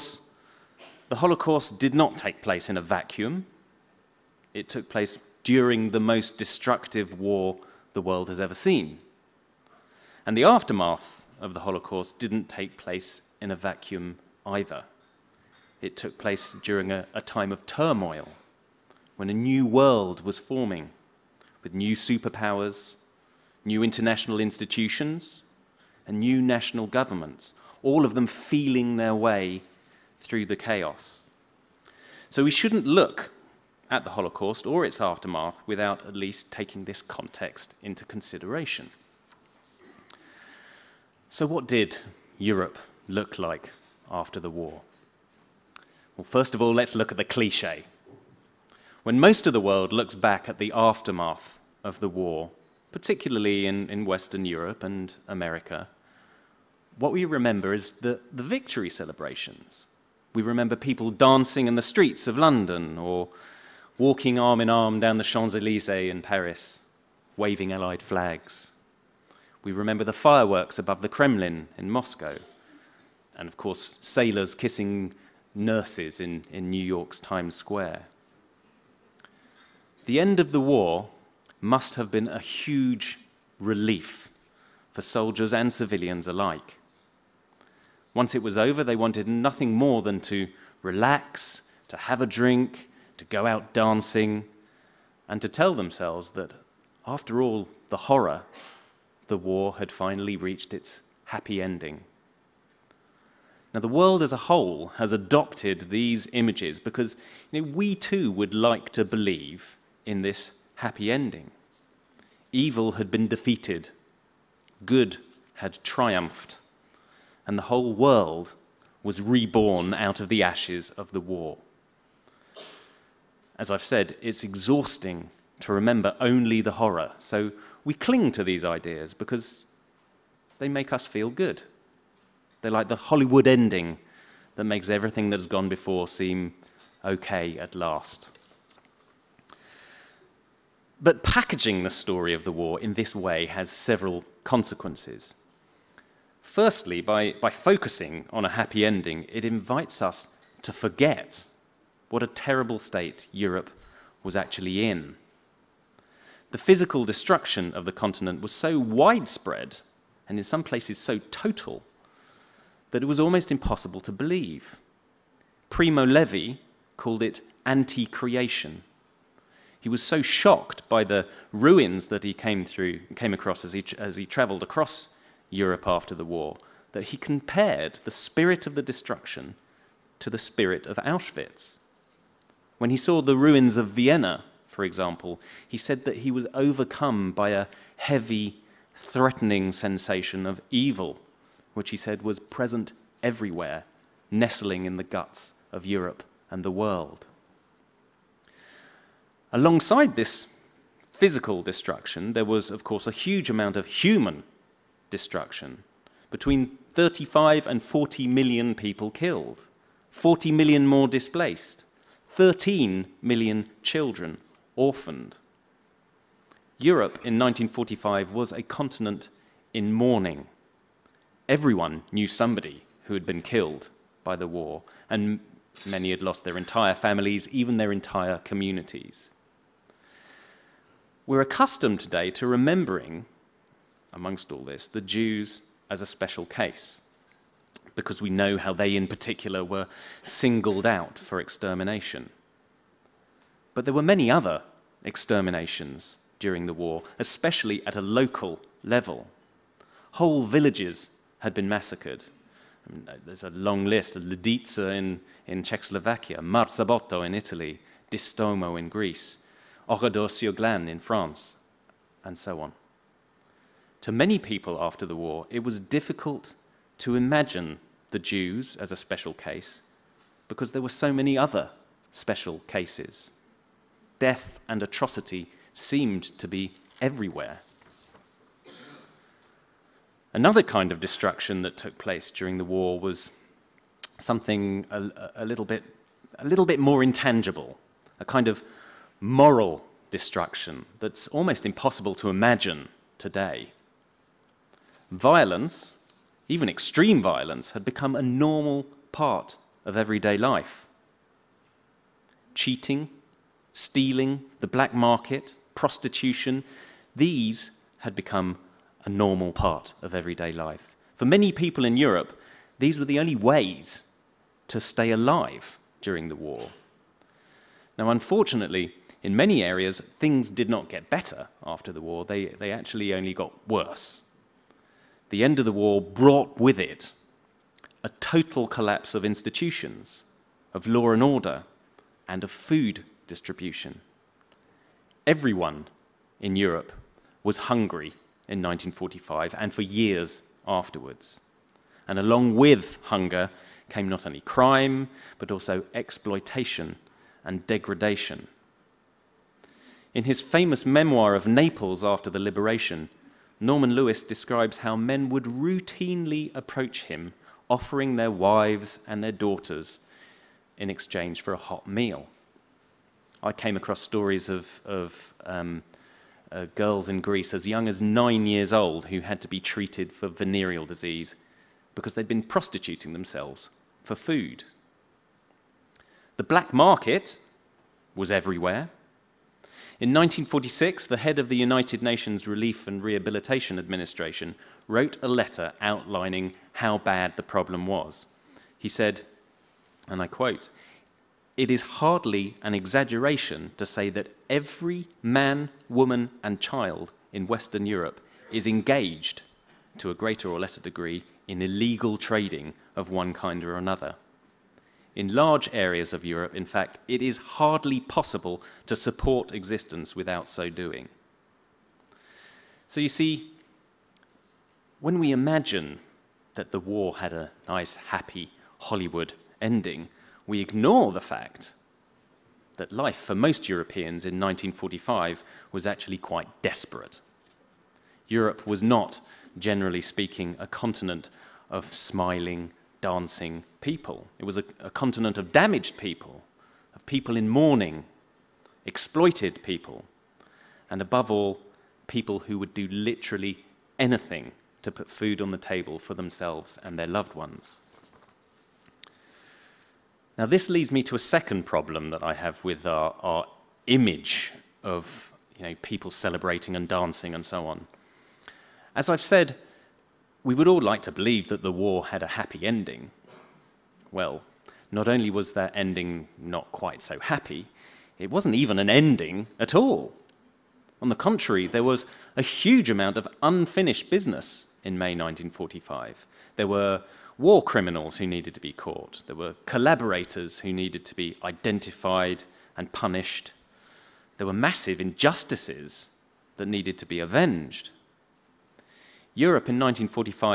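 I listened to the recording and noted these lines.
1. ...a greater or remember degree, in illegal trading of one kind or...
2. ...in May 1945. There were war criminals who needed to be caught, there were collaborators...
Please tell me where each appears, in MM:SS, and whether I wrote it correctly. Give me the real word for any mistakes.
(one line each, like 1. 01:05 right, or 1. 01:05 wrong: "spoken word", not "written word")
1. 06:40 wrong: "lesser", not "remember"
2. 07:54 right.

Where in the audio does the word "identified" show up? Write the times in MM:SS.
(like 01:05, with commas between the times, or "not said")
08:01.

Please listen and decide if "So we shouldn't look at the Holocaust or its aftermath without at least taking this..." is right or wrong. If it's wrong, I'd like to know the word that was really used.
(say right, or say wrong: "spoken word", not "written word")
right.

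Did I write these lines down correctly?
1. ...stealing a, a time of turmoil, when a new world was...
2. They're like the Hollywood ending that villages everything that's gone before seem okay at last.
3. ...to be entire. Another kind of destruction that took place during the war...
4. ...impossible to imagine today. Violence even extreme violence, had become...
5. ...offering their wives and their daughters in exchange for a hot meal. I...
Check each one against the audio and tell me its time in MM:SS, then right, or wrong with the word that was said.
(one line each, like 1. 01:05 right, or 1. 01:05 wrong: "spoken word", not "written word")
1. 00:16 wrong: "during", not "stealing"
2. 02:12 wrong: "makes", not "villages"
3. 04:36 wrong: "everywhere", not "entire"
4. 04:51 right
5. 05:57 right.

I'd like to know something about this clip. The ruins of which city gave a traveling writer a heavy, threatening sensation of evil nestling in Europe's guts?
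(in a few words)
Vienna.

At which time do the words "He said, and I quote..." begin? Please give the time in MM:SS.
06:28.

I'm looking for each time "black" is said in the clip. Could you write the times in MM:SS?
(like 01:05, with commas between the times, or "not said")
05:04, 06:16.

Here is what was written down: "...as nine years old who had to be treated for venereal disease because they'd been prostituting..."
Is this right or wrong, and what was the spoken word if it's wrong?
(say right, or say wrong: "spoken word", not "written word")
right.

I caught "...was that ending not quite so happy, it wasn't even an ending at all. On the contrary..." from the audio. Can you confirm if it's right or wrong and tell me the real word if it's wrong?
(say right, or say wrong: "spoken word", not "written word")
right.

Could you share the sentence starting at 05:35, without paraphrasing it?
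Everyone in Europe was hungry in 1945 and for years afterwards.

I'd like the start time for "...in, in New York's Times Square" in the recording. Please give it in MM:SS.
01:16.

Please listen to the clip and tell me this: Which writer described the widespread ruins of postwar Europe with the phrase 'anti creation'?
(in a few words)
Primo Levi.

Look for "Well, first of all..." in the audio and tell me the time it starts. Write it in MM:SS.
00:46.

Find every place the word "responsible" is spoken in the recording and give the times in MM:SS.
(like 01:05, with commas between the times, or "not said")
not said.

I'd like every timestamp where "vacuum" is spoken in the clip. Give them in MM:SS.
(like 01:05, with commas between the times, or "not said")
00:02, 00:13.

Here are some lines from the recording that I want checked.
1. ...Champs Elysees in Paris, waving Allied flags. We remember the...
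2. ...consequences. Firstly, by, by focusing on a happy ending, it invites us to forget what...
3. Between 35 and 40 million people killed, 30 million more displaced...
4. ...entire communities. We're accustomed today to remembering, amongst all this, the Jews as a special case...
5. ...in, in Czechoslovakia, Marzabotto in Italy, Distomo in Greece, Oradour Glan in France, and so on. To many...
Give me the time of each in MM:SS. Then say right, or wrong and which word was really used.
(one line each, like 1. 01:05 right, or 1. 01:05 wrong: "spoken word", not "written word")
1. 01:05 right
2. 02:24 right
3. 03:26 wrong: "40", not "30"
4. 03:47 right
5. 04:14 right.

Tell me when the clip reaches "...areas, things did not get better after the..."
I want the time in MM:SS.
05:19.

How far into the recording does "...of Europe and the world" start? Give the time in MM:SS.
03:15.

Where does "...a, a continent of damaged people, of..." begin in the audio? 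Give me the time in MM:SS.
07:14.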